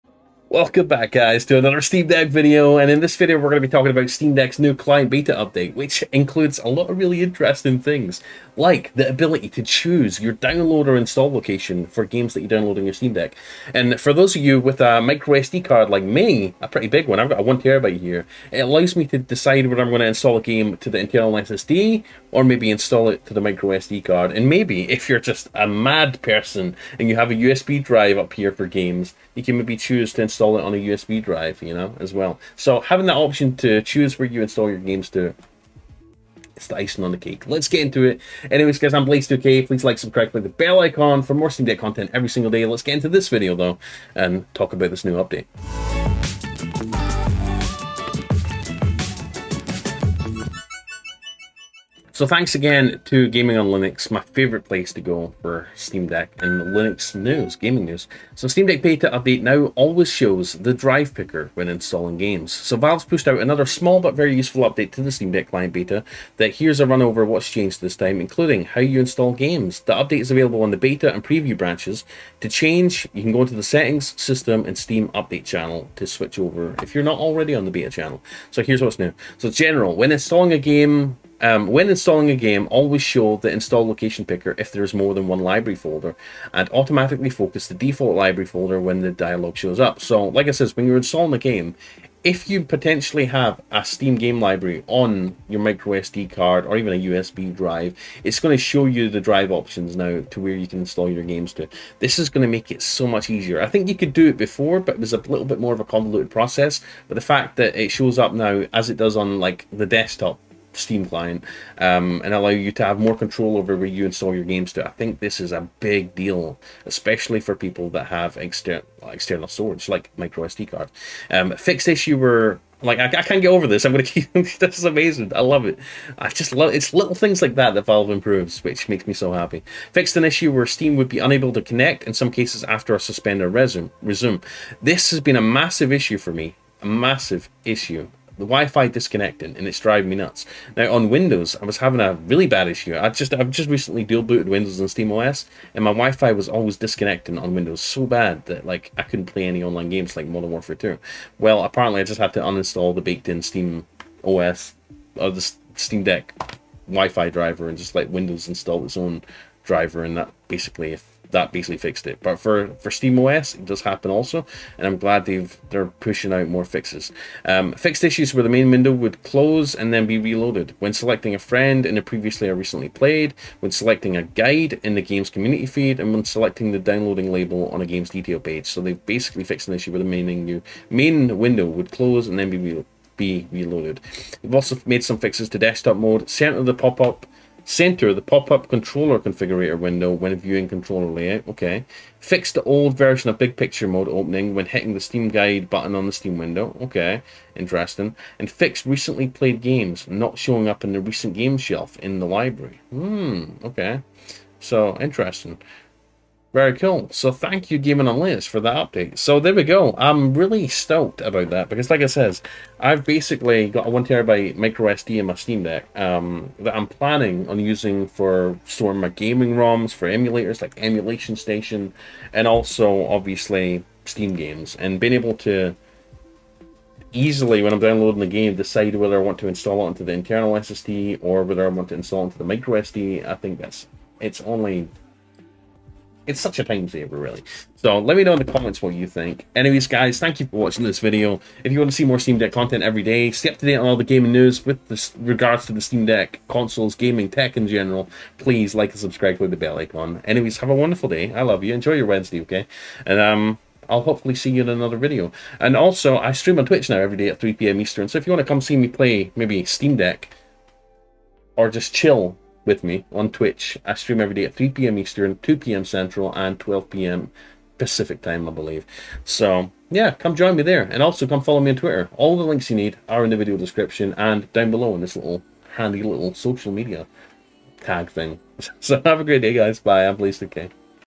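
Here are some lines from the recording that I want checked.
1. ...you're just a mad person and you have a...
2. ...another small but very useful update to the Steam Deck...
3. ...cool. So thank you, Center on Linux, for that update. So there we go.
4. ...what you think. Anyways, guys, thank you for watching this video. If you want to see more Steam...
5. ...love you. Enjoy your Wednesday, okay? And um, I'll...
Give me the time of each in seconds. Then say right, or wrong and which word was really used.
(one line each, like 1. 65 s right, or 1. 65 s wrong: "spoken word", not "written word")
1. 25 s right
2. 63 s right
3. 206 s wrong: "Gaming", not "Center"
4. 238 s right
5. 251 s right.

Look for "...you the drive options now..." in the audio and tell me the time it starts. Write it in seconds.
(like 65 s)
98 s.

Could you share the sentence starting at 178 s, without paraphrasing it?
So they've basically fixed an issue where the main menu, main window would close and then be reloaded be reloaded.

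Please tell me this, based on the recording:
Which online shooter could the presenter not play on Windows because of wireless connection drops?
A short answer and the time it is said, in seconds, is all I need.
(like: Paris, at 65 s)
Modern Warfare 2, at 150 s.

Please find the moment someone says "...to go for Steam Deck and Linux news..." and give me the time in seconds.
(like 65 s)
54 s.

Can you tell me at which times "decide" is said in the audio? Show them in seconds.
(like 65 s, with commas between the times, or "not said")
19 s, 228 s.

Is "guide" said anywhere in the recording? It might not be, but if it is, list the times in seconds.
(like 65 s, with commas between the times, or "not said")
174 s, 195 s.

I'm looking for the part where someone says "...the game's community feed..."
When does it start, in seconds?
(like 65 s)
174 s.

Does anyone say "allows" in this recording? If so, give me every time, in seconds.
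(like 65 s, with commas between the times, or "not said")
18 s, 112 s.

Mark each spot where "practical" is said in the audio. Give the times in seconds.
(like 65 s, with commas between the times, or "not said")
not said.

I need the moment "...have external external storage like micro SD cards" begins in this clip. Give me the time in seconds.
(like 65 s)
118 s.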